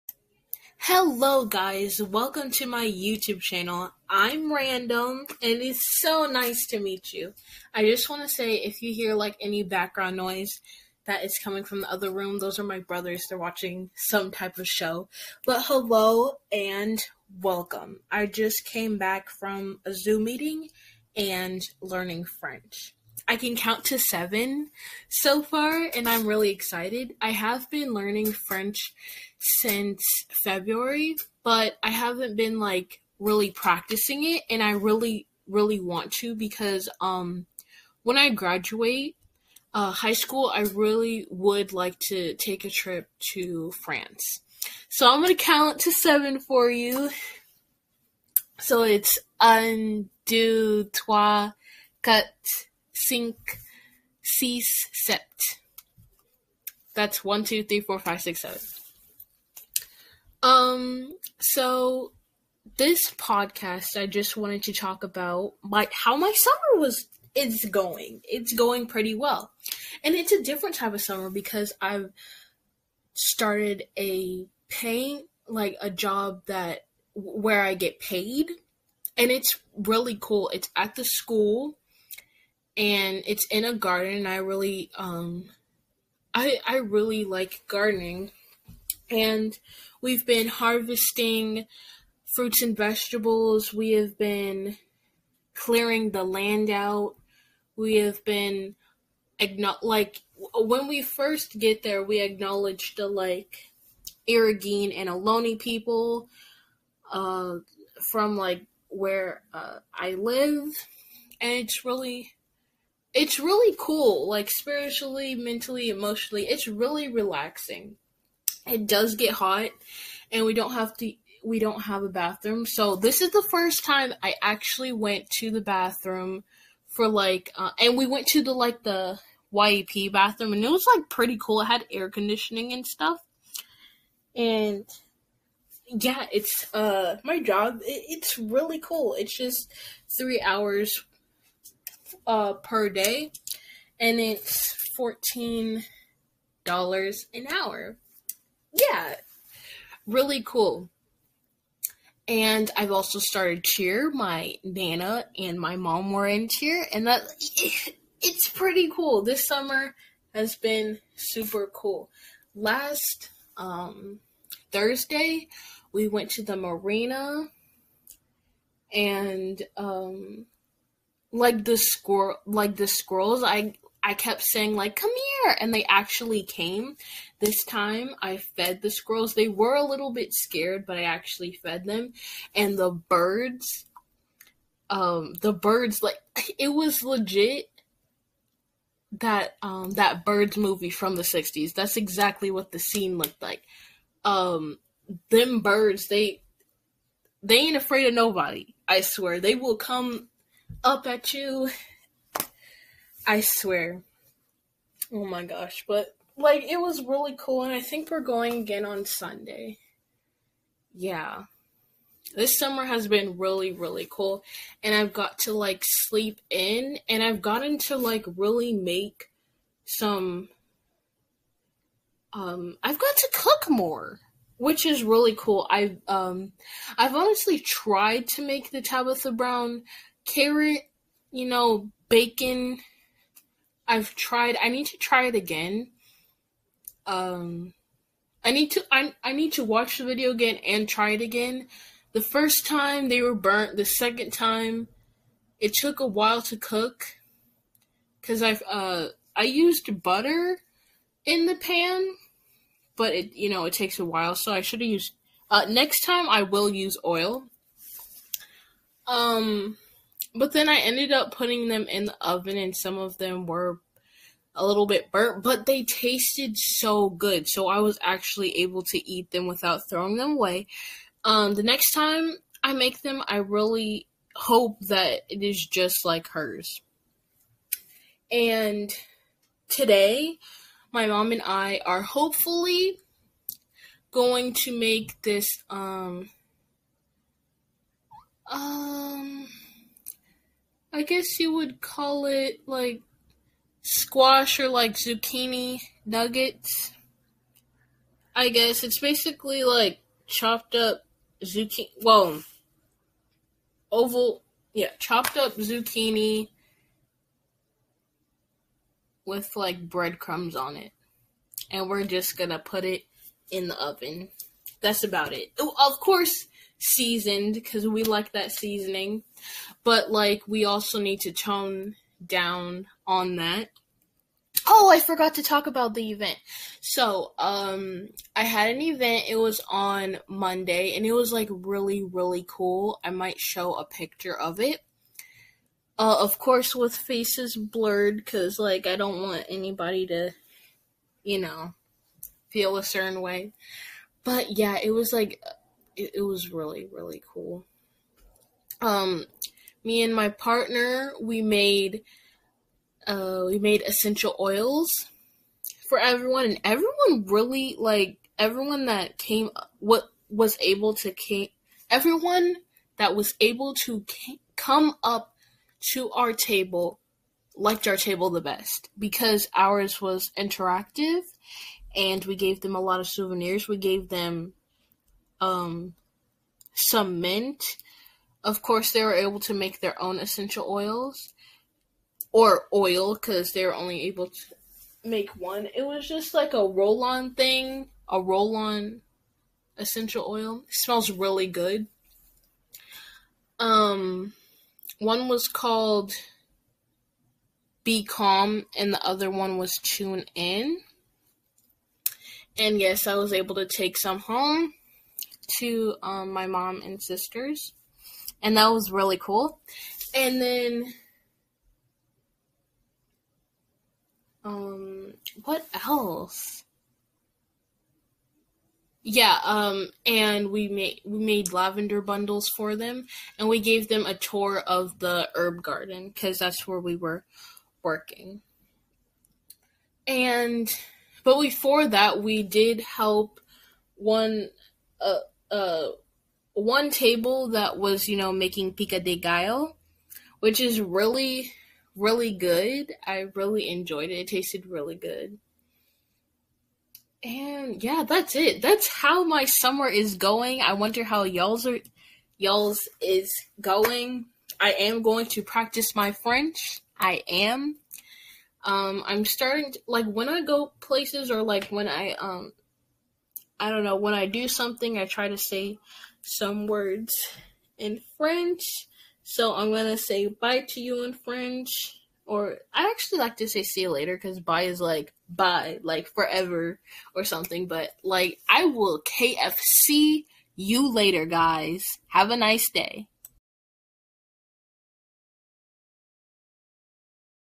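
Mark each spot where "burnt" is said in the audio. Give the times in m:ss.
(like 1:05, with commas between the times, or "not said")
4:03, 4:25.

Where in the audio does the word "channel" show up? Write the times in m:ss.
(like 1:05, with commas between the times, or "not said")
0:03.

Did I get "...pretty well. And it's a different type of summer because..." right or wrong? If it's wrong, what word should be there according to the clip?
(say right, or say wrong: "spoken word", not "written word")
right.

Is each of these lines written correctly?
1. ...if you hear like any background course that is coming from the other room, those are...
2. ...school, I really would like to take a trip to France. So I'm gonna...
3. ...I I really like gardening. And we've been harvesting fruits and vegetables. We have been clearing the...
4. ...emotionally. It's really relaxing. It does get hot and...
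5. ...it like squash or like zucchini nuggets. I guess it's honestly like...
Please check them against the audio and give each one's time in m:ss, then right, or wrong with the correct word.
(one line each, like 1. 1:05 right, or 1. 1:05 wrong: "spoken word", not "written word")
1. 0:08 wrong: "noise", not "course"
2. 0:40 right
3. 1:26 right
4. 1:55 right
5. 4:52 wrong: "basically", not "honestly".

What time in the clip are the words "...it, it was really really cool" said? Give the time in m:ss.
5:46.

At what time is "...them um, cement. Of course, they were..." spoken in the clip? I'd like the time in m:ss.
6:14.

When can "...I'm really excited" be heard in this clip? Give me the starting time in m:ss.
0:26.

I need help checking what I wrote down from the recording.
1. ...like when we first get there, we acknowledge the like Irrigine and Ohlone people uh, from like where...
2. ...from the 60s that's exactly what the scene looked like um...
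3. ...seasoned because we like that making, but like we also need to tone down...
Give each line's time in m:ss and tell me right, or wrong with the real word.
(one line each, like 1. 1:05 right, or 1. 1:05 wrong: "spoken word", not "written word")
1. 1:39 right
2. 3:10 right
3. 5:16 wrong: "seasoning", not "making".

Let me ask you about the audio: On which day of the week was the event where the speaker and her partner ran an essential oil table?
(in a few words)
Monday.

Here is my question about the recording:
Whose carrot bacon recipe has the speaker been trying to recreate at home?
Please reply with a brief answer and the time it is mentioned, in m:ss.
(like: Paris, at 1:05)
Tabitha Brown, at 3:48.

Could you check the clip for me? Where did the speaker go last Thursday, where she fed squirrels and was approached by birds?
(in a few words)
the marina.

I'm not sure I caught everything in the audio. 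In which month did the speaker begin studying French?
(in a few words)
February.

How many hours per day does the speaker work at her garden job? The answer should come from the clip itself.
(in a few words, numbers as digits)
3.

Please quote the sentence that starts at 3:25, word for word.
But, like, it was really cool, and I think we're going again on Sunday.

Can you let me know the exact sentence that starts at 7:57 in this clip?
But like, I will KFC you later, guys.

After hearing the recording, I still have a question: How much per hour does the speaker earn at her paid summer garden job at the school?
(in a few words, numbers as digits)
$14.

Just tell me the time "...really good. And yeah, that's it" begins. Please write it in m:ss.
7:24.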